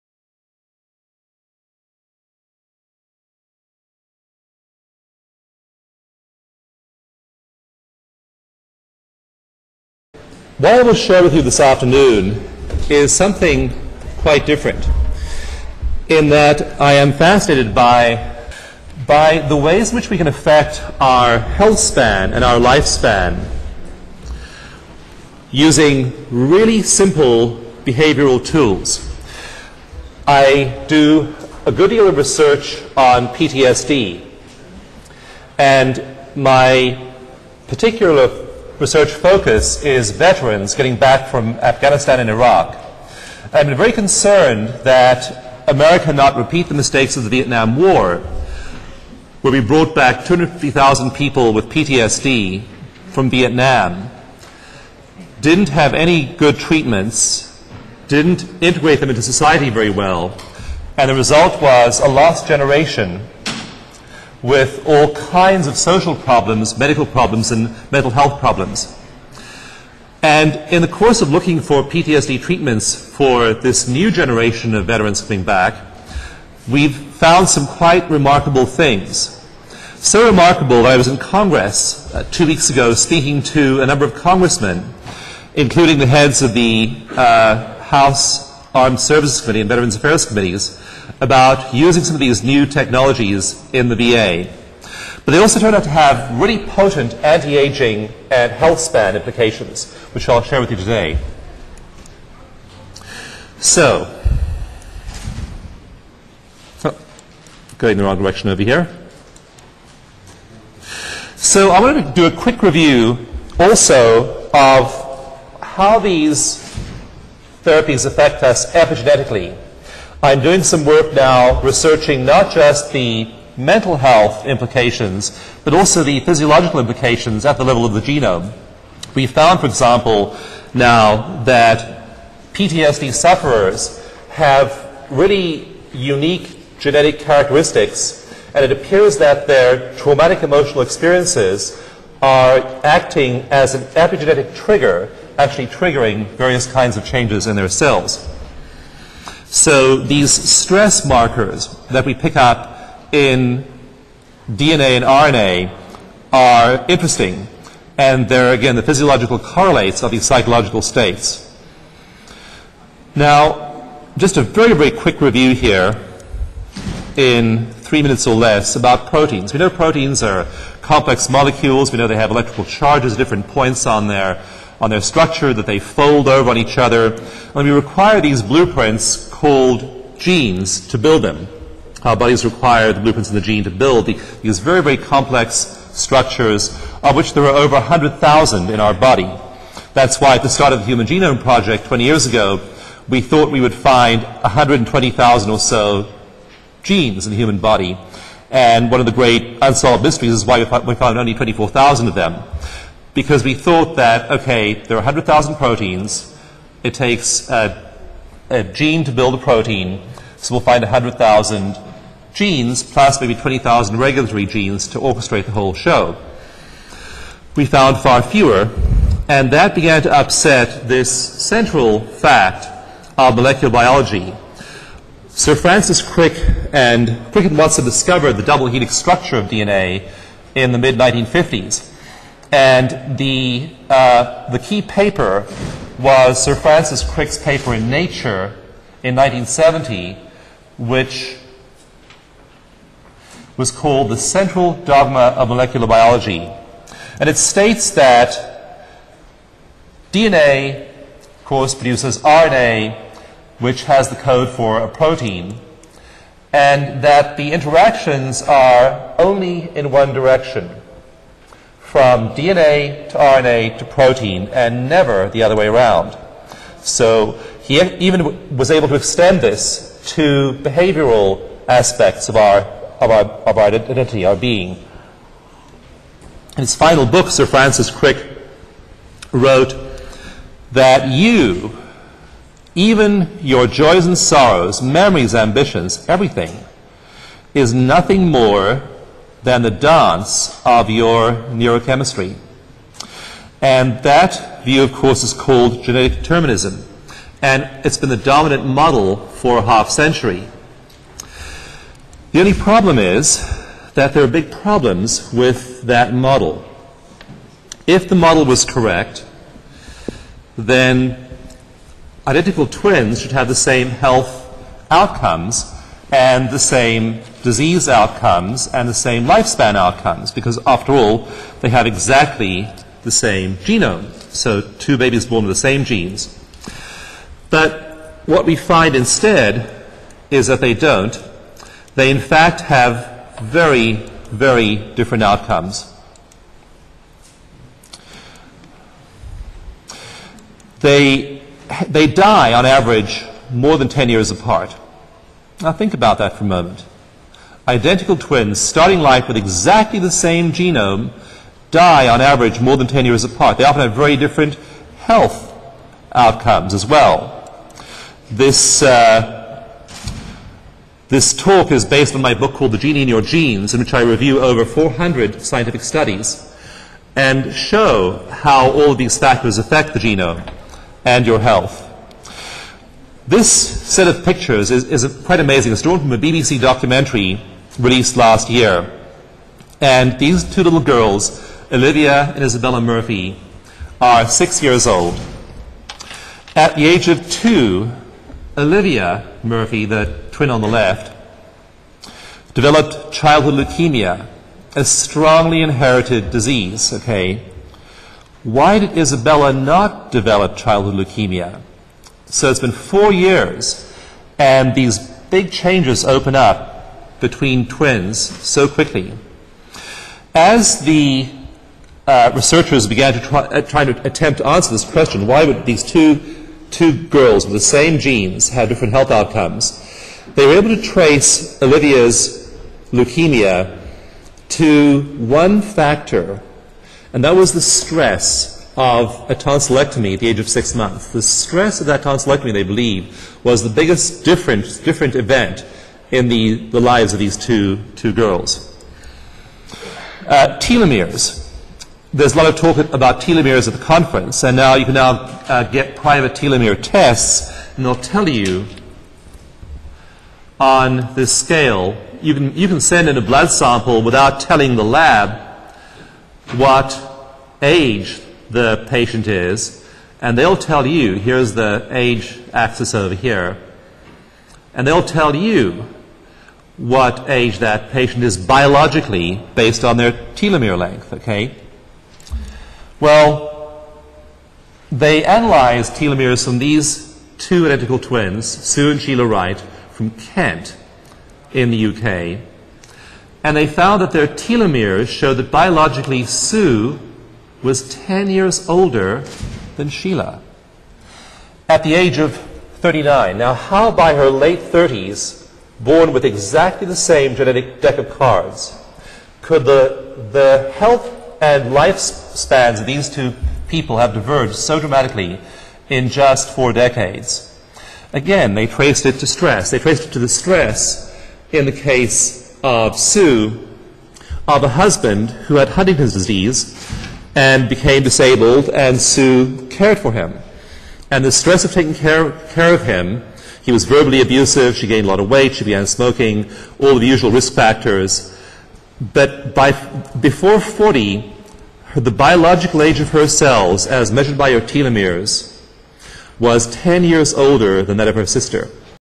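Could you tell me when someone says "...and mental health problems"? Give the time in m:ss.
1:07.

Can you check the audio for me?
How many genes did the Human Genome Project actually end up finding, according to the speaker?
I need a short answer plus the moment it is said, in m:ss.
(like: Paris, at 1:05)
24,000, at 3:21.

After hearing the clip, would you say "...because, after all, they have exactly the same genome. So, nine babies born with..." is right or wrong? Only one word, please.
wrong.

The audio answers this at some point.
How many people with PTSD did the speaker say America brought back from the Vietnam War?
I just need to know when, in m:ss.
0:50.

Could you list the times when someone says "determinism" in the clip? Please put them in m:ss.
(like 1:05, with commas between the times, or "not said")
4:56.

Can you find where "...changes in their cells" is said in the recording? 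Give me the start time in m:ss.
2:27.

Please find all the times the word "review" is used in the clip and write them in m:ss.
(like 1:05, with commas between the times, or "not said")
1:52, 2:45, 6:04.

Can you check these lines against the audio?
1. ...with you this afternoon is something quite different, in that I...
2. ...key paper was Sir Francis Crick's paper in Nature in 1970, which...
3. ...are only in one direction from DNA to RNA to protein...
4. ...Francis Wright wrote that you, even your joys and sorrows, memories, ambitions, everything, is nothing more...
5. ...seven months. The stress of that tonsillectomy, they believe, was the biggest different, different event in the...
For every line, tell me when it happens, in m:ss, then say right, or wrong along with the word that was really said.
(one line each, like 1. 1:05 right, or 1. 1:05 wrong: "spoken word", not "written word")
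1. 0:11 right
2. 3:54 right
3. 4:18 right
4. 4:37 wrong: "Crick", not "Wright"
5. 7:10 wrong: "six", not "seven".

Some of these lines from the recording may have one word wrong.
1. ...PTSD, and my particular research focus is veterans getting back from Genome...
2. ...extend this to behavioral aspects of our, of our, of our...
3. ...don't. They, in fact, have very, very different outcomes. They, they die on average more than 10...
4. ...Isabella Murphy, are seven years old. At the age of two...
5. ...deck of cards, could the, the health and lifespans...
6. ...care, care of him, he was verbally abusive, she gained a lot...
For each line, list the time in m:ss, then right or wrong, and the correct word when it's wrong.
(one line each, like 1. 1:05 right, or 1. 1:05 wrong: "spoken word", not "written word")
1. 0:33 wrong: "Afghanistan", not "Genome"
2. 4:28 right
3. 5:30 right
4. 6:22 wrong: "six", not "seven"
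5. 8:17 right
6. 8:41 right.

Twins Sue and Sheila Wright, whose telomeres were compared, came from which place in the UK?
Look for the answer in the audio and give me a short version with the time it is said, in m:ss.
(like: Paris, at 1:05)
Kent, at 8:00.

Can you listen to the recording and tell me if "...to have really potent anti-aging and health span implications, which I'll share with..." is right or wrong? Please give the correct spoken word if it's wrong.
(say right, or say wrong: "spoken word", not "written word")
right.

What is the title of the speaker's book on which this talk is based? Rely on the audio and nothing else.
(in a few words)
The Genie in Your Genes.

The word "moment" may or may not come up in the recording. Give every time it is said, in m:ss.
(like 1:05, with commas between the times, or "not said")
5:46.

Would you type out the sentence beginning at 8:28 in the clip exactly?
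Again, they traced it to stress.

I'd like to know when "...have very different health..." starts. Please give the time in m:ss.
5:53.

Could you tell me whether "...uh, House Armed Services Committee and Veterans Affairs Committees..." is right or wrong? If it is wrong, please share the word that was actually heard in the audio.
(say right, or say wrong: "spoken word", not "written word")
right.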